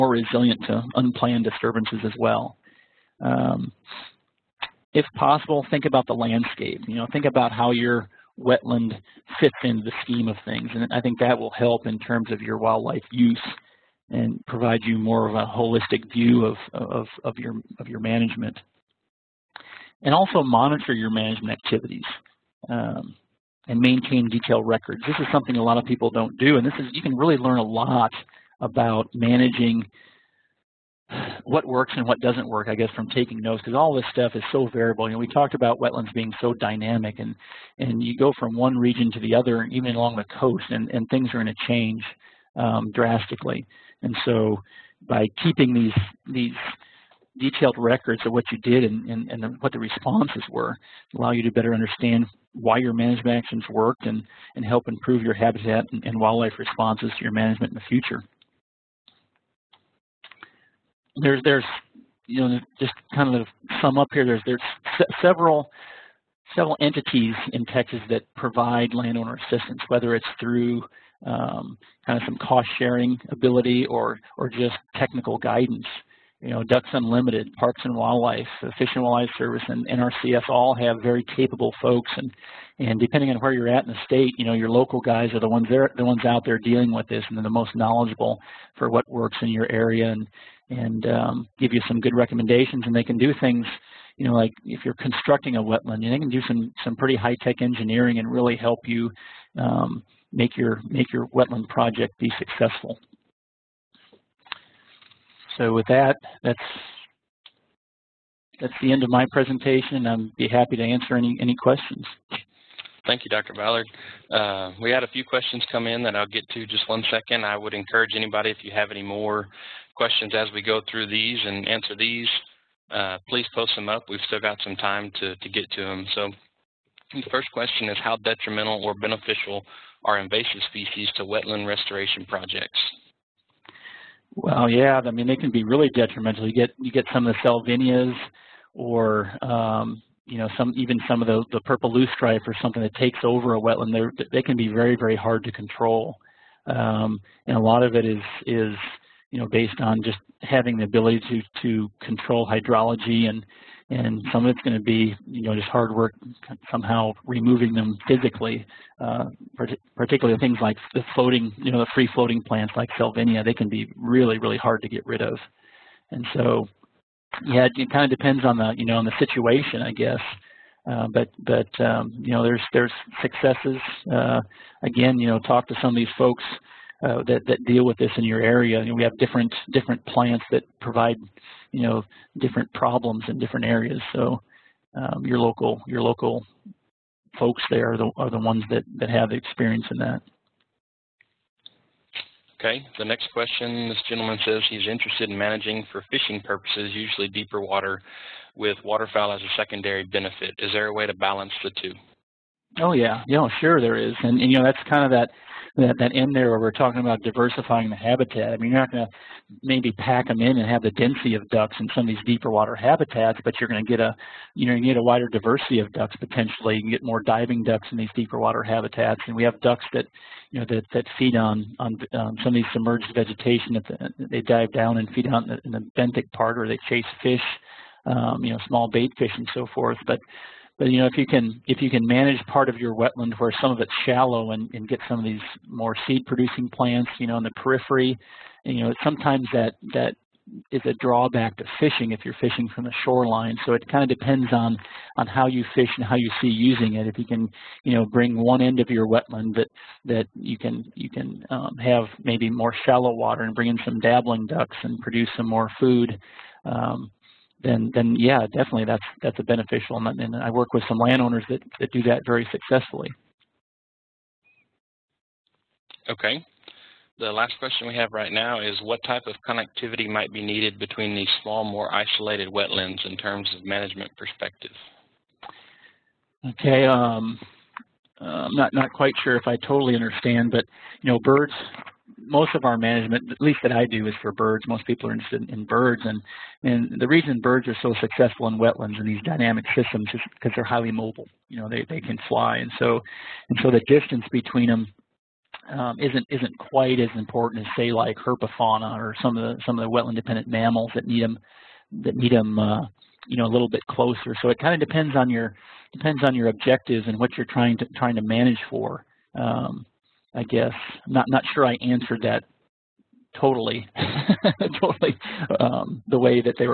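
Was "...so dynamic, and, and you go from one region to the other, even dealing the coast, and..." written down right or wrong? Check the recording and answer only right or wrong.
wrong.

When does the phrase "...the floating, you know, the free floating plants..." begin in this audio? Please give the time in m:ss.
2:40.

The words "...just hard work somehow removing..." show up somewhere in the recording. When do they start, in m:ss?
2:35.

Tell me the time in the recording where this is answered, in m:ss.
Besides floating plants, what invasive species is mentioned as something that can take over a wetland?
2:21.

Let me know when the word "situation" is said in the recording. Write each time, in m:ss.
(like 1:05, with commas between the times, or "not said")
2:49.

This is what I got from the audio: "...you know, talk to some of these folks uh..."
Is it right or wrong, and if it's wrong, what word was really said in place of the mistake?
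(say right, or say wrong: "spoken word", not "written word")
right.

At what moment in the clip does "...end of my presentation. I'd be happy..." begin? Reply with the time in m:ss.
1:48.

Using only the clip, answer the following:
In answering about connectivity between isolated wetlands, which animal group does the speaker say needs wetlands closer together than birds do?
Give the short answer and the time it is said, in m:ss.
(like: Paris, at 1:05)
herpetofauna, at 4:58.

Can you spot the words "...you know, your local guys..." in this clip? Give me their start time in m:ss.
1:24.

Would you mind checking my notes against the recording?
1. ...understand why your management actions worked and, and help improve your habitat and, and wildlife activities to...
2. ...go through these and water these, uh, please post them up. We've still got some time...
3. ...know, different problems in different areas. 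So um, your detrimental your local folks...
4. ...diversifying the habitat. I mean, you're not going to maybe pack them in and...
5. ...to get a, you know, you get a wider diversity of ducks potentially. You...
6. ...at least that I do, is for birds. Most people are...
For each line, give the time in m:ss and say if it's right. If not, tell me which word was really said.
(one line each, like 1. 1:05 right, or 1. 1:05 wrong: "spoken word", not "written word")
1. 0:51 wrong: "responses", not "activities"
2. 2:00 wrong: "answer", not "water"
3. 3:01 wrong: "local", not "detrimental"
4. 3:27 right
5. 3:33 right
6. 4:43 right.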